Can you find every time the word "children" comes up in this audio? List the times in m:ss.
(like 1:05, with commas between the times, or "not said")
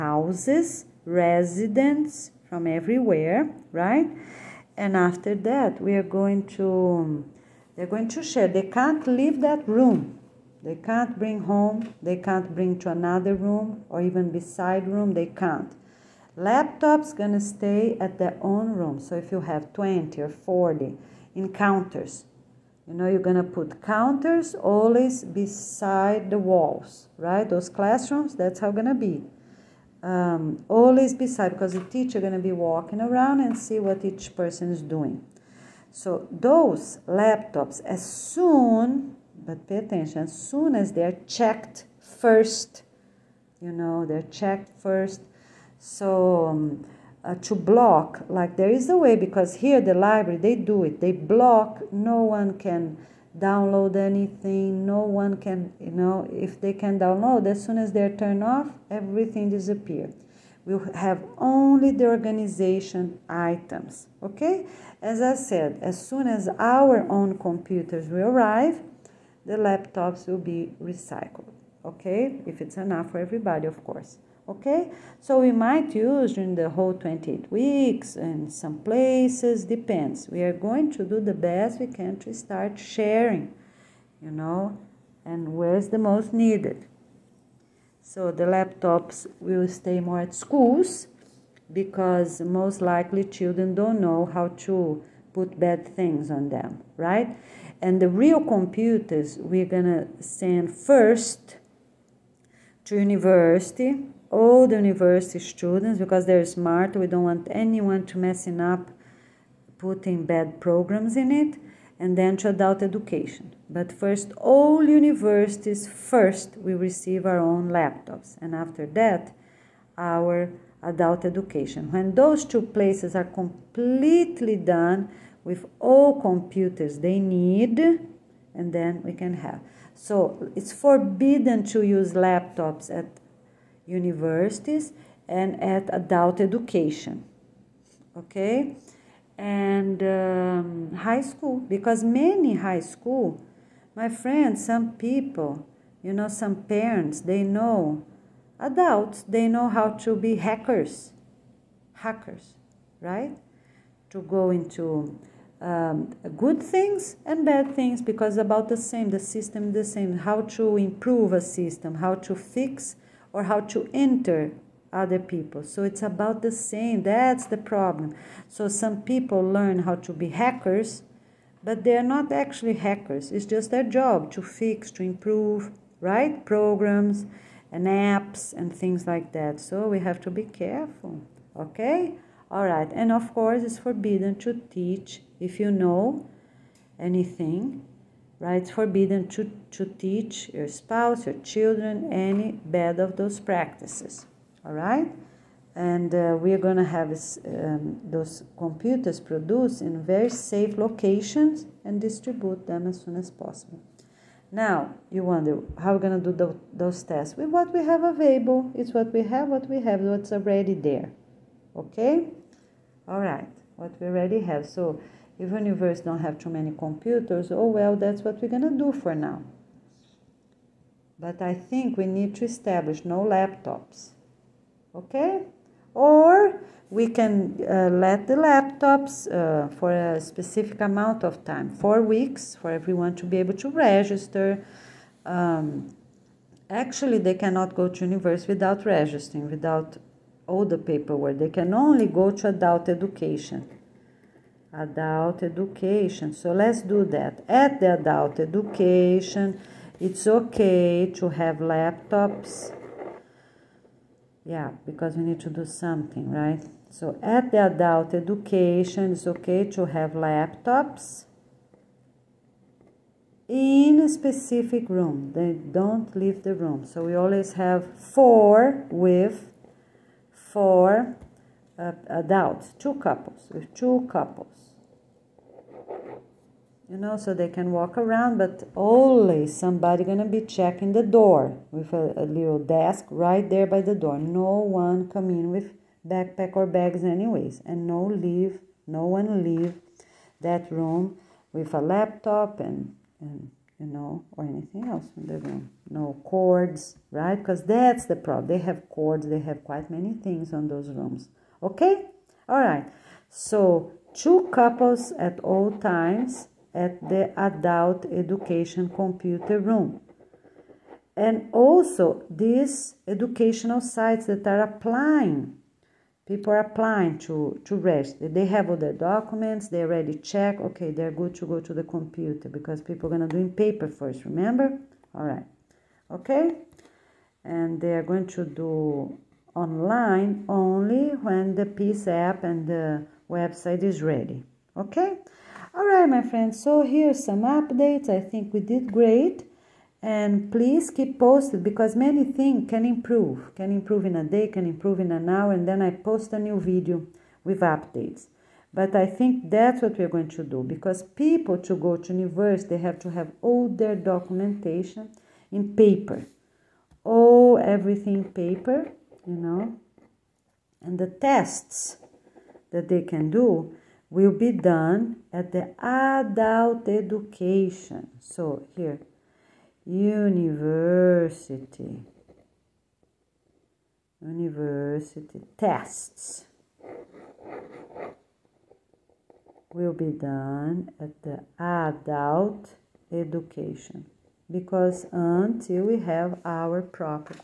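1:33, 3:11.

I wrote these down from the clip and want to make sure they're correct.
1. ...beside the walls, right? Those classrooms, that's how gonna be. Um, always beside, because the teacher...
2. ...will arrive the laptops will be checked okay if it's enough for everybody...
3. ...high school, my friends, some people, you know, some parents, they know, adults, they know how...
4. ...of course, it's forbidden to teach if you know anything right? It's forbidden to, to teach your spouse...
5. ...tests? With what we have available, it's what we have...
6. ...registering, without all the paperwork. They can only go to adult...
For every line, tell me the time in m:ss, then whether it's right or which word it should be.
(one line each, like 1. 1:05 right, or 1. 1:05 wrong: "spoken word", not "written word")
1. 0:25 right
2. 1:08 wrong: "recycled", not "checked"
3. 2:22 right
4. 3:03 right
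5. 3:27 right
6. 3:58 right.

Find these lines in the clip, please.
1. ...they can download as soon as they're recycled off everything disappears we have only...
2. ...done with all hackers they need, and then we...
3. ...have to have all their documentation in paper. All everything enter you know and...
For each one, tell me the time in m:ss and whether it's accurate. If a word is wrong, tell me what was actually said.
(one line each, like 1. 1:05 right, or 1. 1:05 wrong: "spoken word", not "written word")
1. 0:56 wrong: "turned", not "recycled"
2. 2:04 wrong: "computers", not "hackers"
3. 5:52 wrong: "paper", not "enter".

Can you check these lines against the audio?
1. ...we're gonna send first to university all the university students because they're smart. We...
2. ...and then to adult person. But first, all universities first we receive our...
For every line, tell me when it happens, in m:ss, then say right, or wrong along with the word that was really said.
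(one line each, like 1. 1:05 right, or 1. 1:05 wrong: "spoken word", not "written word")
1. 1:39 right
2. 1:51 wrong: "education", not "person".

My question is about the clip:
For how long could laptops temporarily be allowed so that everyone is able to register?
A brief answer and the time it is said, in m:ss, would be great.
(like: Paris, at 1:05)
4 weeks, at 3:51.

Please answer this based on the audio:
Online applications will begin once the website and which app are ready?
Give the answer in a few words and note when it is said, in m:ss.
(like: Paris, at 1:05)
peace app, at 5:31.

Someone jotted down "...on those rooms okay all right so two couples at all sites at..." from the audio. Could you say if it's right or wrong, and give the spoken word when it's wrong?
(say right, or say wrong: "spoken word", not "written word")
wrong: "times", not "sites".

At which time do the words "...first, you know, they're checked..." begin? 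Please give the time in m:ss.
0:41.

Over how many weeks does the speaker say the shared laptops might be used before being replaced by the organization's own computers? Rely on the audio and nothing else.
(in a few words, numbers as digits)
28.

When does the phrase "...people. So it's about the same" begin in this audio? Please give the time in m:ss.
2:45.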